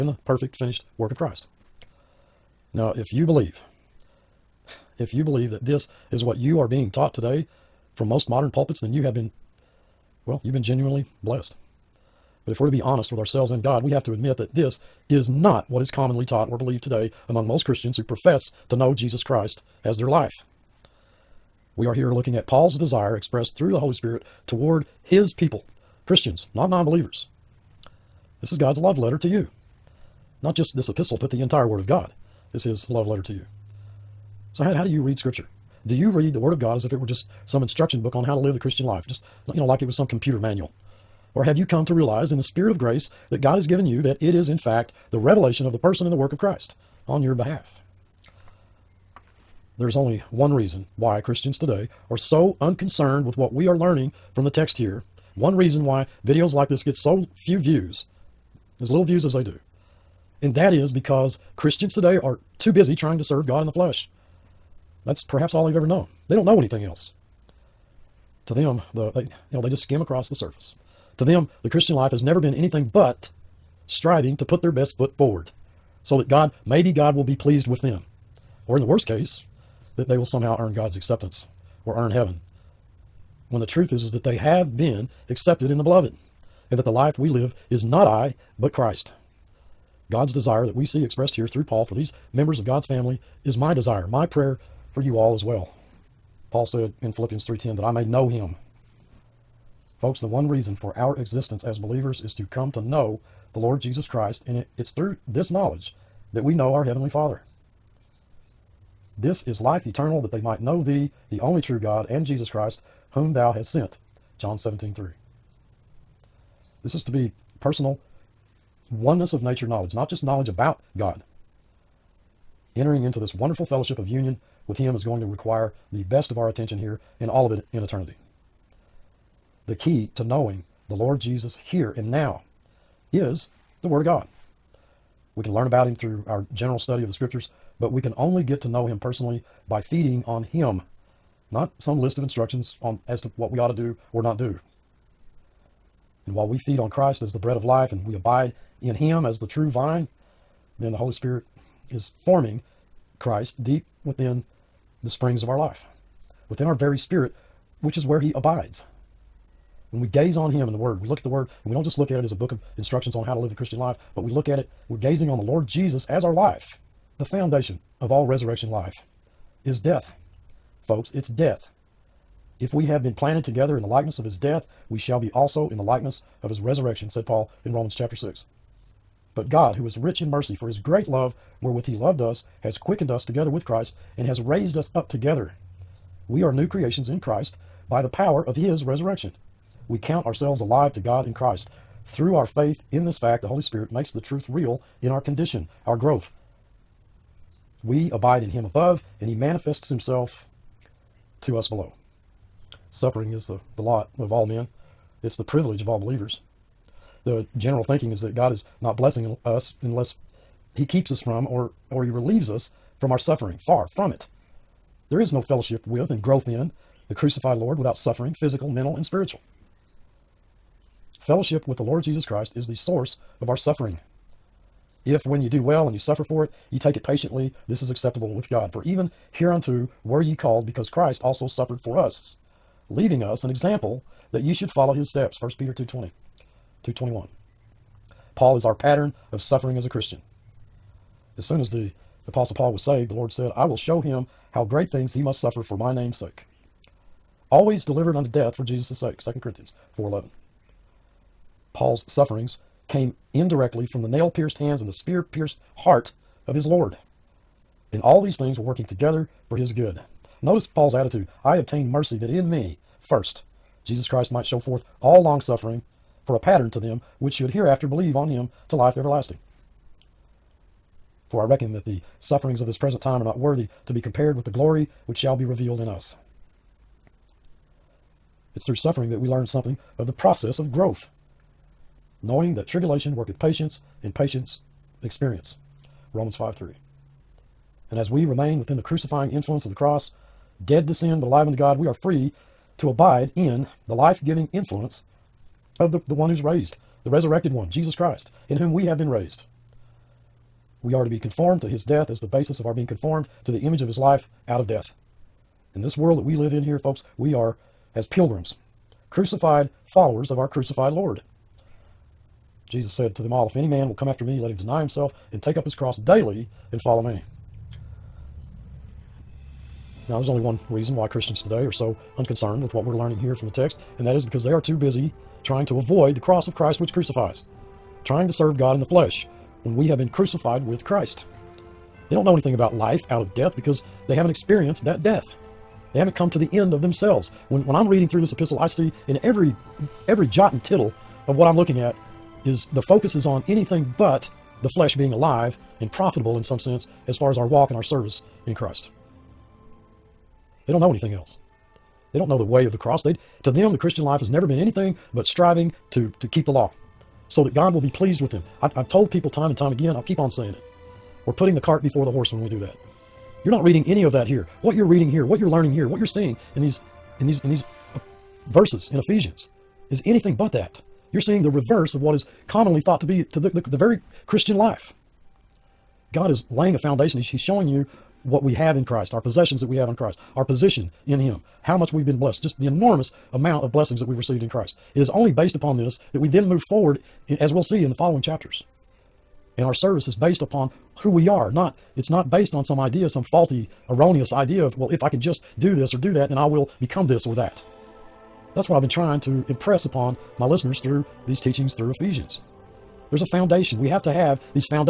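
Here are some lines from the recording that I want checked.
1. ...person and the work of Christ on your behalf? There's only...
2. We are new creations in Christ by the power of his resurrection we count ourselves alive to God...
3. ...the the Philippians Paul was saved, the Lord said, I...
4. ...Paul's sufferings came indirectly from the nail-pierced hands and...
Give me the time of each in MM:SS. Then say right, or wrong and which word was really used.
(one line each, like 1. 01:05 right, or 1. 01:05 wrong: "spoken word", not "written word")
1. 00:45 right
2. 03:06 right
3. 04:01 wrong: "Apostle", not "Philippians"
4. 04:11 right.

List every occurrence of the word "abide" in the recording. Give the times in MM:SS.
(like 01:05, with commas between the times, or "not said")
02:28, 02:38, 03:18, 04:52.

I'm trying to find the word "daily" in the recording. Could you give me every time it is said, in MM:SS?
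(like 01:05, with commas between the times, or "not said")
05:15.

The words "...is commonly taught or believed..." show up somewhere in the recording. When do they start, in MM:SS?
00:15.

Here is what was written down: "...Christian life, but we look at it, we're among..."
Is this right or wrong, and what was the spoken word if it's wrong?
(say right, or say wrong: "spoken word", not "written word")
wrong: "gazing", not "among".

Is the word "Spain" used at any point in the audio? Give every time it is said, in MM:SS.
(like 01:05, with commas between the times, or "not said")
not said.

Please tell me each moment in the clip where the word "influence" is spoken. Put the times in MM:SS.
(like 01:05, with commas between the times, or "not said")
04:49, 04:54.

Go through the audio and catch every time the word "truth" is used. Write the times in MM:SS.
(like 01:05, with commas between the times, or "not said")
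01:23, 03:14.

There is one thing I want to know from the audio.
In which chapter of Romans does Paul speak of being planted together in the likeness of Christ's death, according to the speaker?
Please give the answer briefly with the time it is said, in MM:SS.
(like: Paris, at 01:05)
Romans chapter 6, at 02:57.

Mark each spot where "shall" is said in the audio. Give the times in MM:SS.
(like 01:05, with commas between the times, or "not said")
02:54, 04:35.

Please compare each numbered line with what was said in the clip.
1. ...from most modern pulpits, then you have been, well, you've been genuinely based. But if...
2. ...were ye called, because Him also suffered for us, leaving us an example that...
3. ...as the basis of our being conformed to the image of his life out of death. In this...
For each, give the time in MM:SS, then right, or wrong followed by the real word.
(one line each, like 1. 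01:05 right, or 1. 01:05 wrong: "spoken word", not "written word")
1. 00:07 wrong: "blessed", not "based"
2. 03:50 wrong: "Christ", not "Him"
3. 05:02 right.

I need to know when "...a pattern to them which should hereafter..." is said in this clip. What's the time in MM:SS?
04:26.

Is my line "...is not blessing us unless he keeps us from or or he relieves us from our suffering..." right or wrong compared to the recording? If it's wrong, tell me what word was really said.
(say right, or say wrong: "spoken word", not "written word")
right.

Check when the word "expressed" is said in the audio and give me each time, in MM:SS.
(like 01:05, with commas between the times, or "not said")
00:23, 01:31.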